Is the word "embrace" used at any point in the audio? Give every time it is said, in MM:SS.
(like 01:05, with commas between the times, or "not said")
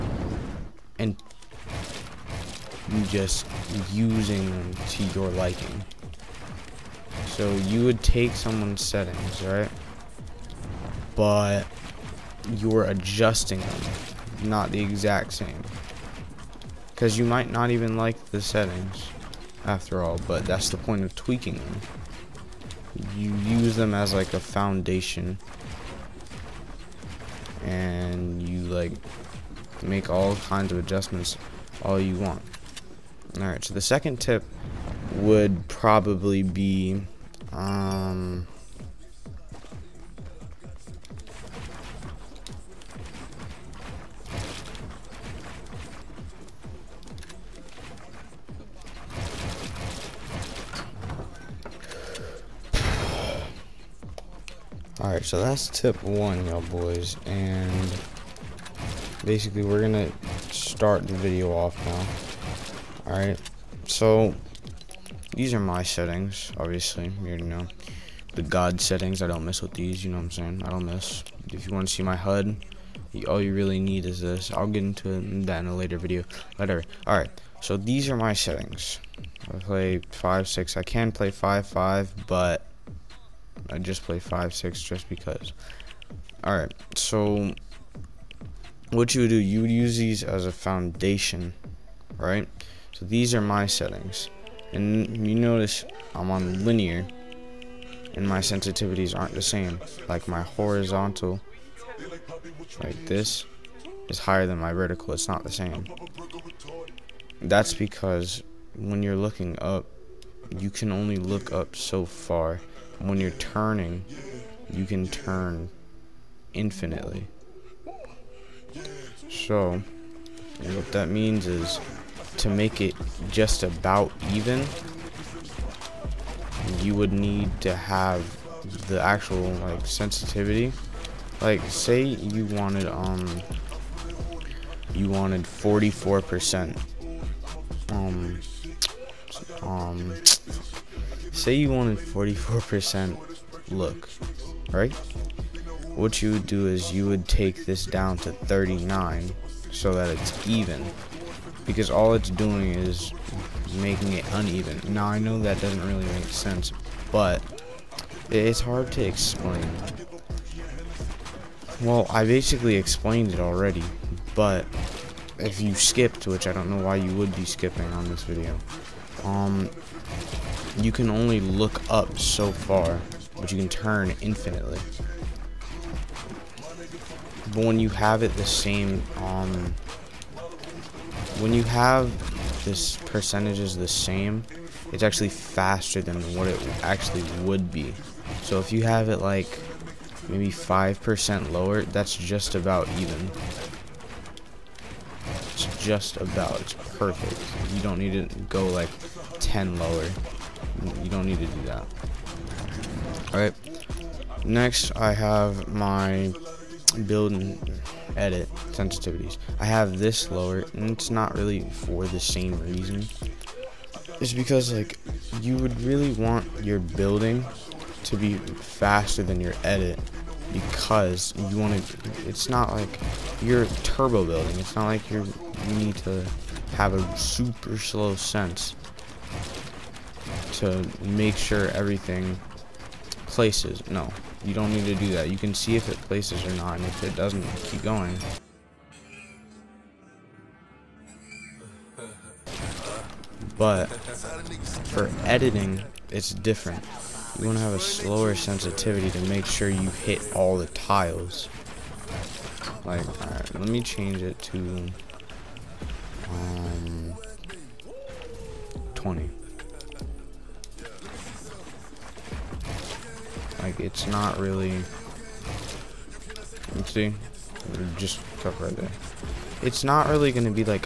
not said.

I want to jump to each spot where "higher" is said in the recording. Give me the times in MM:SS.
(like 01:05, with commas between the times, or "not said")
01:44.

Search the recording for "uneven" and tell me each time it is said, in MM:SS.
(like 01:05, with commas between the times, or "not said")
02:34.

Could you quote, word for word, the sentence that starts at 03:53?
No, you don't need to do that.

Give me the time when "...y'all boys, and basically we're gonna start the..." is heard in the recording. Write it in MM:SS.
00:56.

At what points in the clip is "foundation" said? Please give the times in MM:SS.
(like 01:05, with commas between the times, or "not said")
00:24, 01:30.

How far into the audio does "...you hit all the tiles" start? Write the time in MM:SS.
04:09.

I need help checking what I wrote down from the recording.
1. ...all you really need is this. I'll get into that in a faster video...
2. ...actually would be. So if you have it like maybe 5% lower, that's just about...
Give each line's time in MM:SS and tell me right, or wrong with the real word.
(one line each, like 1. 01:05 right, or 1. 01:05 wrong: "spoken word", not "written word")
1. 01:13 wrong: "later", not "faster"
2. 03:06 right.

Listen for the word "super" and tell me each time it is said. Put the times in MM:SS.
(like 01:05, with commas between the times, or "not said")
03:47.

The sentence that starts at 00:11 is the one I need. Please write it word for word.
But you're adjusting them, not the exact same.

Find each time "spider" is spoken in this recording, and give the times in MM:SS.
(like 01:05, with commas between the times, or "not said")
not said.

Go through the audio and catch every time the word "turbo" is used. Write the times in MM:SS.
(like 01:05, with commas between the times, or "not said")
03:43.